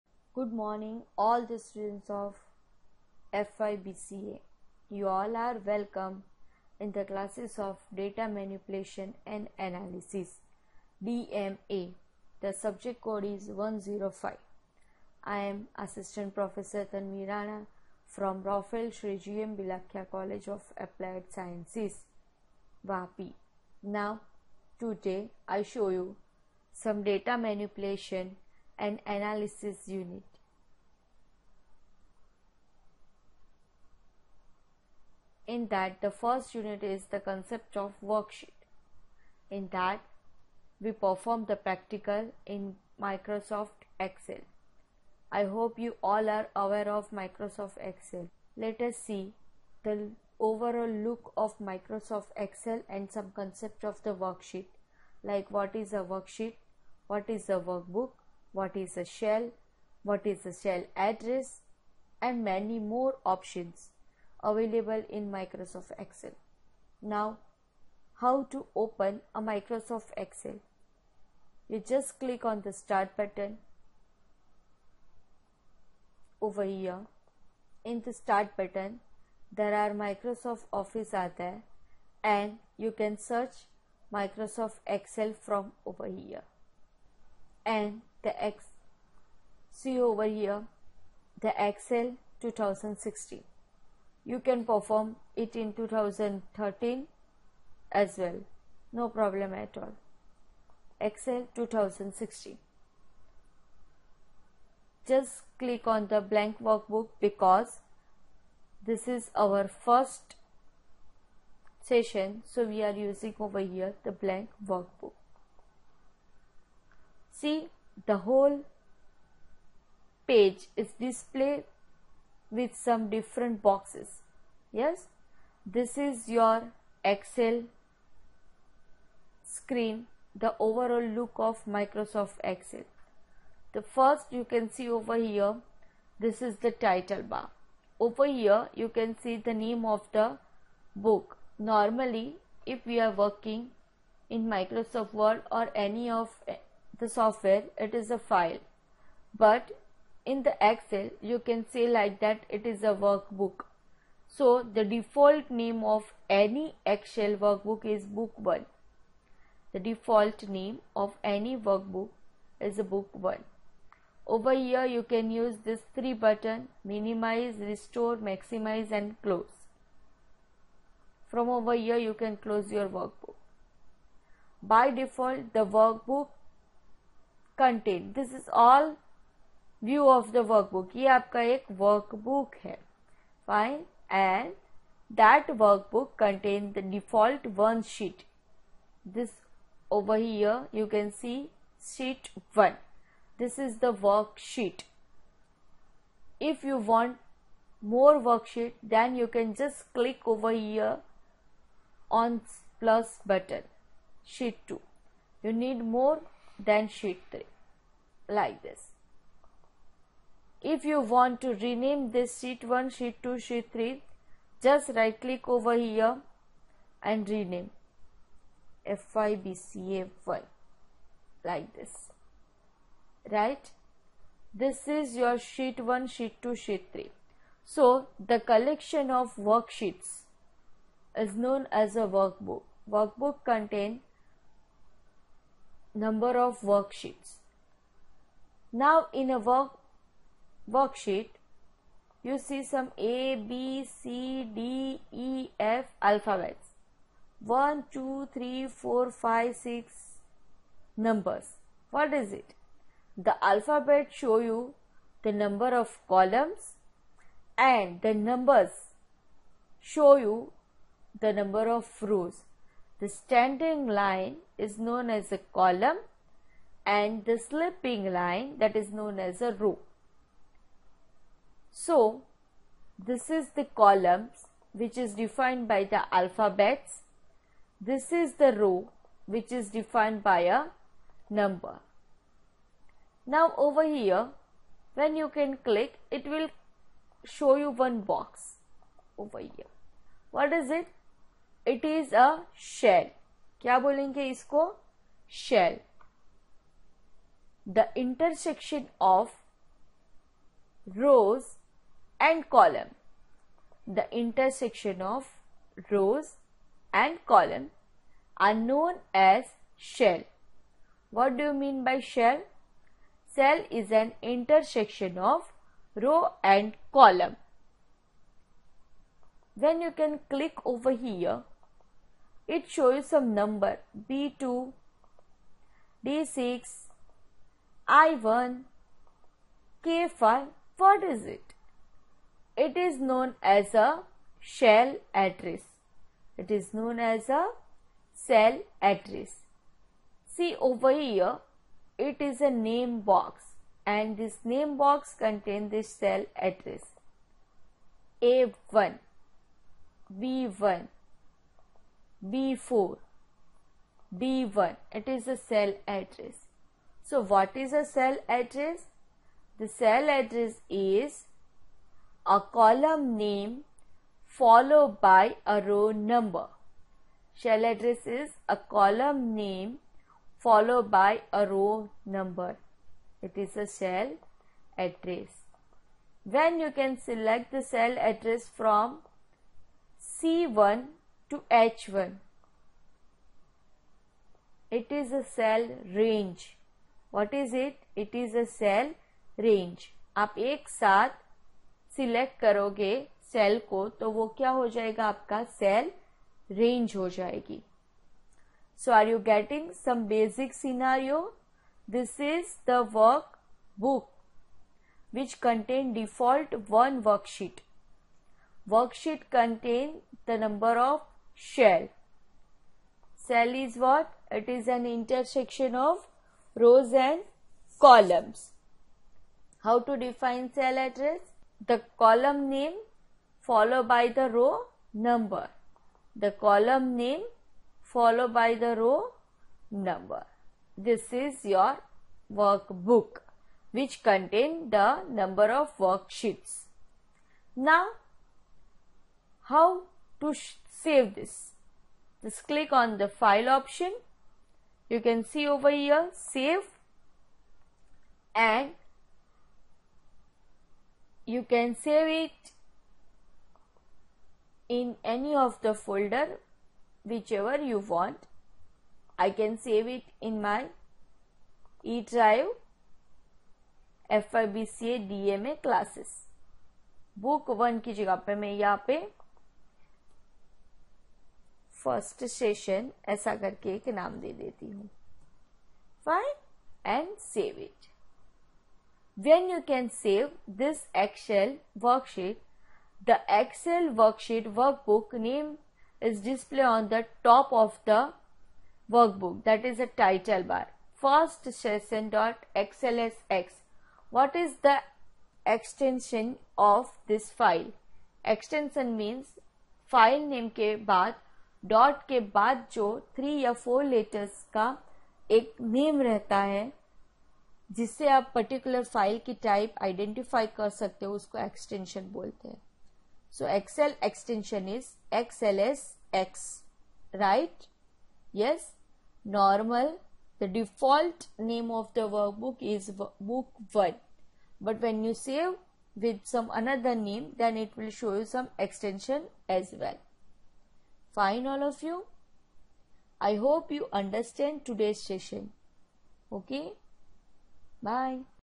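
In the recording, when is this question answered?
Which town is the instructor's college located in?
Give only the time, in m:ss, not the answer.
0:22.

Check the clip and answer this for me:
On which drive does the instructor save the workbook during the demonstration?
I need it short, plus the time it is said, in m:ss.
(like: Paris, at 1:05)
E drive, at 7:41.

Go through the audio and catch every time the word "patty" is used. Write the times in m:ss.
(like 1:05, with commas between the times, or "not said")
not said.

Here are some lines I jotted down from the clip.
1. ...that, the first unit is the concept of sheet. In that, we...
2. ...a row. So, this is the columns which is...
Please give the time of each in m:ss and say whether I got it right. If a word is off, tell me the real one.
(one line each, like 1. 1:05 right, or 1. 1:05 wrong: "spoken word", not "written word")
1. 0:35 wrong: "worksheet", not "sheet"
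2. 4:29 right.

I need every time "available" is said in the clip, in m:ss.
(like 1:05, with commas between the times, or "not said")
1:04.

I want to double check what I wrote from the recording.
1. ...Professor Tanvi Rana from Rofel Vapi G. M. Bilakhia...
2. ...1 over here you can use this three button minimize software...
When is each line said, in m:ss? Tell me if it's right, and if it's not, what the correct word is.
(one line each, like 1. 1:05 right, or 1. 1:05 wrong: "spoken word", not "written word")
1. 0:16 wrong: "Sri", not "Vapi"
2. 2:43 wrong: "restore", not "software".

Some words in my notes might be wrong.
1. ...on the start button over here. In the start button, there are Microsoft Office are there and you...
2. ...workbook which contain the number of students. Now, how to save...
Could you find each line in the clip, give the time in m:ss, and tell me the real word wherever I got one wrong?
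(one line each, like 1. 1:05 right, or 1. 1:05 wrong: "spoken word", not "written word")
1. 1:12 right
2. 7:12 wrong: "worksheets", not "students".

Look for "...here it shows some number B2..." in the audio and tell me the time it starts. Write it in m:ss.
5:21.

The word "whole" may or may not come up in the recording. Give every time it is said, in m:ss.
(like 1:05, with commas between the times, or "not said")
1:58.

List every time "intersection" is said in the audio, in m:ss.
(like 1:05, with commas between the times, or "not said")
5:04, 5:14, 6:54.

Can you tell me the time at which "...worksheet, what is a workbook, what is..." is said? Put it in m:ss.
0:56.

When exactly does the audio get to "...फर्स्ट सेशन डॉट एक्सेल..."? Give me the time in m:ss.
8:11.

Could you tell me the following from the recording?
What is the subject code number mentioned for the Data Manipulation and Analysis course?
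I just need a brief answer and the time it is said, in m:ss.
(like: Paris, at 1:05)
105, at 0:12.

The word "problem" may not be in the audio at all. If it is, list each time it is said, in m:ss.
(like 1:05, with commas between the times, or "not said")
1:39.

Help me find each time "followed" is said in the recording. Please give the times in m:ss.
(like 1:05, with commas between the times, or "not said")
6:04, 6:10, 7:03, 7:07.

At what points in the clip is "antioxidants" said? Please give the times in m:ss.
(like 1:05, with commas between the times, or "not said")
not said.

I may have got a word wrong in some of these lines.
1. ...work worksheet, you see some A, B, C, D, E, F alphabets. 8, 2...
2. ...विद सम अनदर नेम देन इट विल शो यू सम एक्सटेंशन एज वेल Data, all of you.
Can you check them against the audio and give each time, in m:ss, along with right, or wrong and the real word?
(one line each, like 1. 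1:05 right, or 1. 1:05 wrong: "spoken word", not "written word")
1. 3:59 wrong: "1", not "8"
2. 8:45 wrong: "Fine", not "Data".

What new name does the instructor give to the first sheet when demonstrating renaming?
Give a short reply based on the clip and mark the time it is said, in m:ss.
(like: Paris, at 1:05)
FYBCA1, at 3:39.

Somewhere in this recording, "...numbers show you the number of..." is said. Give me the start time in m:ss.
4:18.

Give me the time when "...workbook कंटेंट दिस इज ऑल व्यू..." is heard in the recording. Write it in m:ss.
2:55.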